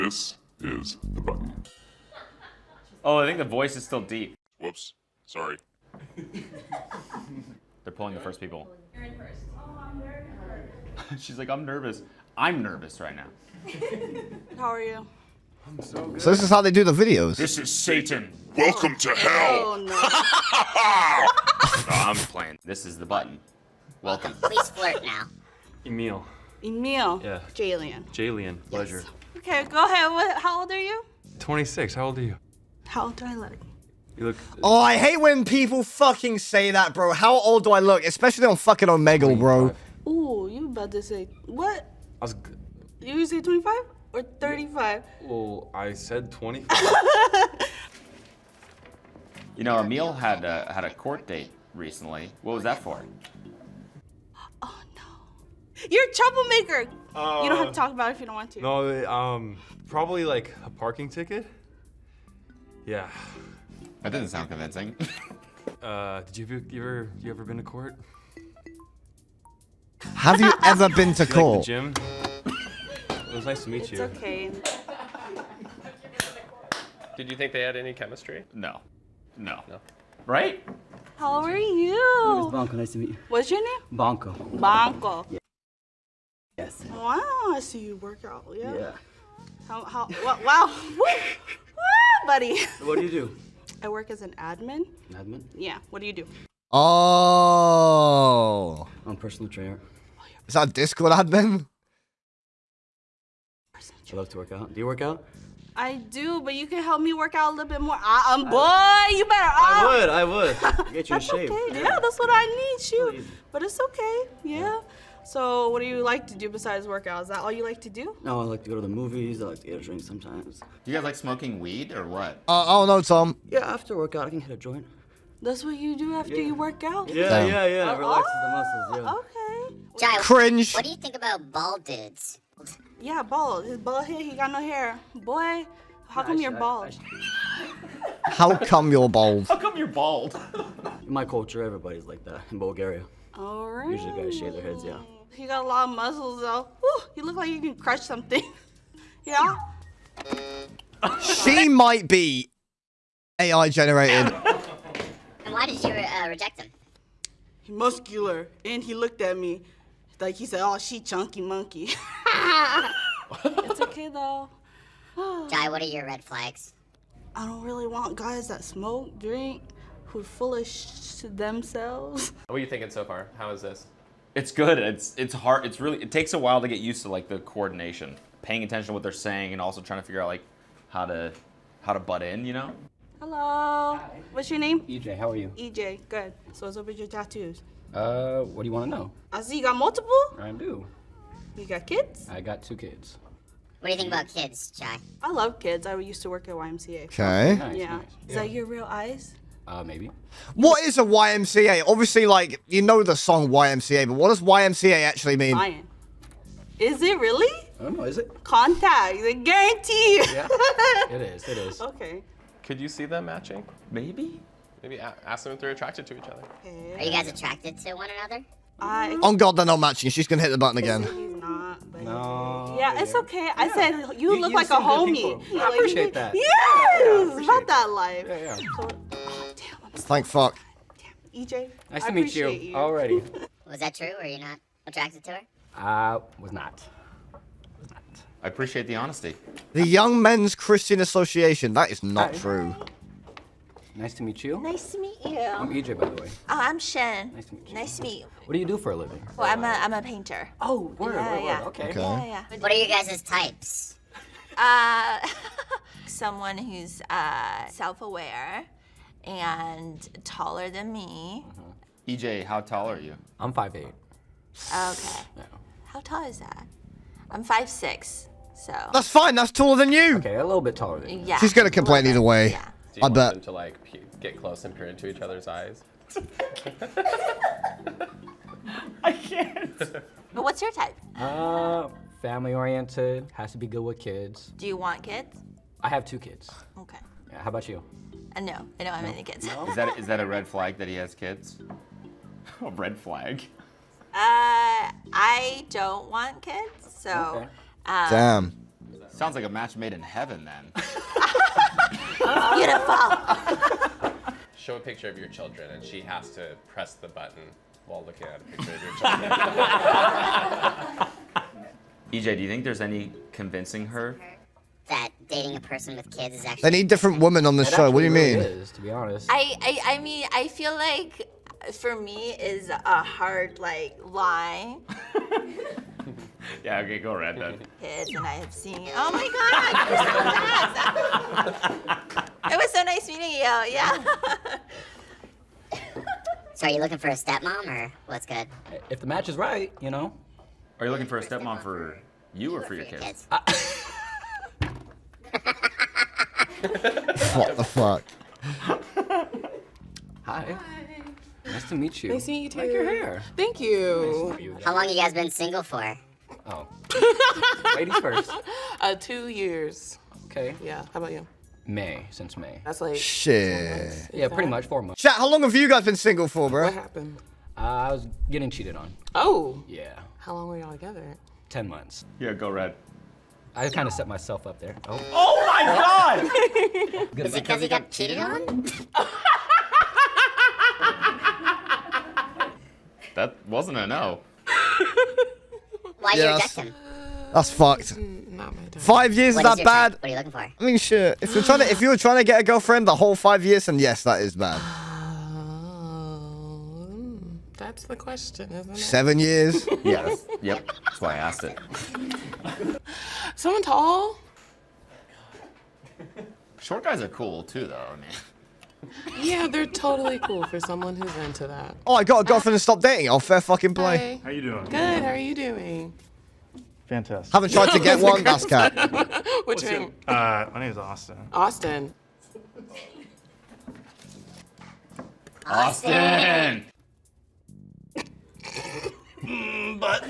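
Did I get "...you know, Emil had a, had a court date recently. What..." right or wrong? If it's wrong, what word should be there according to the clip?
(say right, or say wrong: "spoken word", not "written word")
right.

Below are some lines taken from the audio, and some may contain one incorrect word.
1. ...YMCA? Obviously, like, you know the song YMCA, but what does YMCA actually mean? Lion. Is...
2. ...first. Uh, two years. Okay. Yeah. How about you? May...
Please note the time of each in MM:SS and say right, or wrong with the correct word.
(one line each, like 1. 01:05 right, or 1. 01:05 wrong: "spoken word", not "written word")
1. 03:21 right
2. 05:57 right.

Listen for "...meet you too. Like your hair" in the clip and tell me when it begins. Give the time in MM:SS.
05:52.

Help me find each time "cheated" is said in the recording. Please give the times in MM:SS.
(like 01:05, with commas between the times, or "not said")
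06:08, 06:17.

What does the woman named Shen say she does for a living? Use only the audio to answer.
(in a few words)
Painter.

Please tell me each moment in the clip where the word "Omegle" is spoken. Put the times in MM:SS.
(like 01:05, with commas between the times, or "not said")
00:38.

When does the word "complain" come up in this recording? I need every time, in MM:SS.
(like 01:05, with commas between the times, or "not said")
04:31.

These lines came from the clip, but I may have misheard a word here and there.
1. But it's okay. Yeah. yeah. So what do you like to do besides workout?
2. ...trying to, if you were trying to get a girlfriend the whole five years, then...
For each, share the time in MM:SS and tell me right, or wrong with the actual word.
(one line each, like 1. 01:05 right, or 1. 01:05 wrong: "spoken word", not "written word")
1. 01:53 right
2. 06:31 right.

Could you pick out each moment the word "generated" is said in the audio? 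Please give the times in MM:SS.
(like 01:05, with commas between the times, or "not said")
02:33.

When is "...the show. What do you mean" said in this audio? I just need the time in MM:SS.
05:17.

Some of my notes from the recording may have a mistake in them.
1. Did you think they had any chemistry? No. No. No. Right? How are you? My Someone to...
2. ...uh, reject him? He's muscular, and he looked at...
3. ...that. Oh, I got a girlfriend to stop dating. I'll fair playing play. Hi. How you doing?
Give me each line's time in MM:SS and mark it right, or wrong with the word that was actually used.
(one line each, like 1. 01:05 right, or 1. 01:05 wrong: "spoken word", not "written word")
1. 01:17 wrong: "Nice", not "Someone"
2. 02:35 right
3. 06:51 wrong: "fucking", not "playing".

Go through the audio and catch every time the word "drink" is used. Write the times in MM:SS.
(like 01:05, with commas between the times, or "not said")
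01:59, 02:49.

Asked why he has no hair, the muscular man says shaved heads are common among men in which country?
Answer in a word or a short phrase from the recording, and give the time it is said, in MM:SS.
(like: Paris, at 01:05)
Bulgaria, at 02:22.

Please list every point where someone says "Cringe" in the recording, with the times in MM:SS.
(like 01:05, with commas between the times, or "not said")
02:10.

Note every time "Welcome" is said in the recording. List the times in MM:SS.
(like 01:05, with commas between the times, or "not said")
00:18, 00:24.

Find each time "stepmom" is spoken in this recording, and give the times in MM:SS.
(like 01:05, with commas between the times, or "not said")
05:37, 05:41.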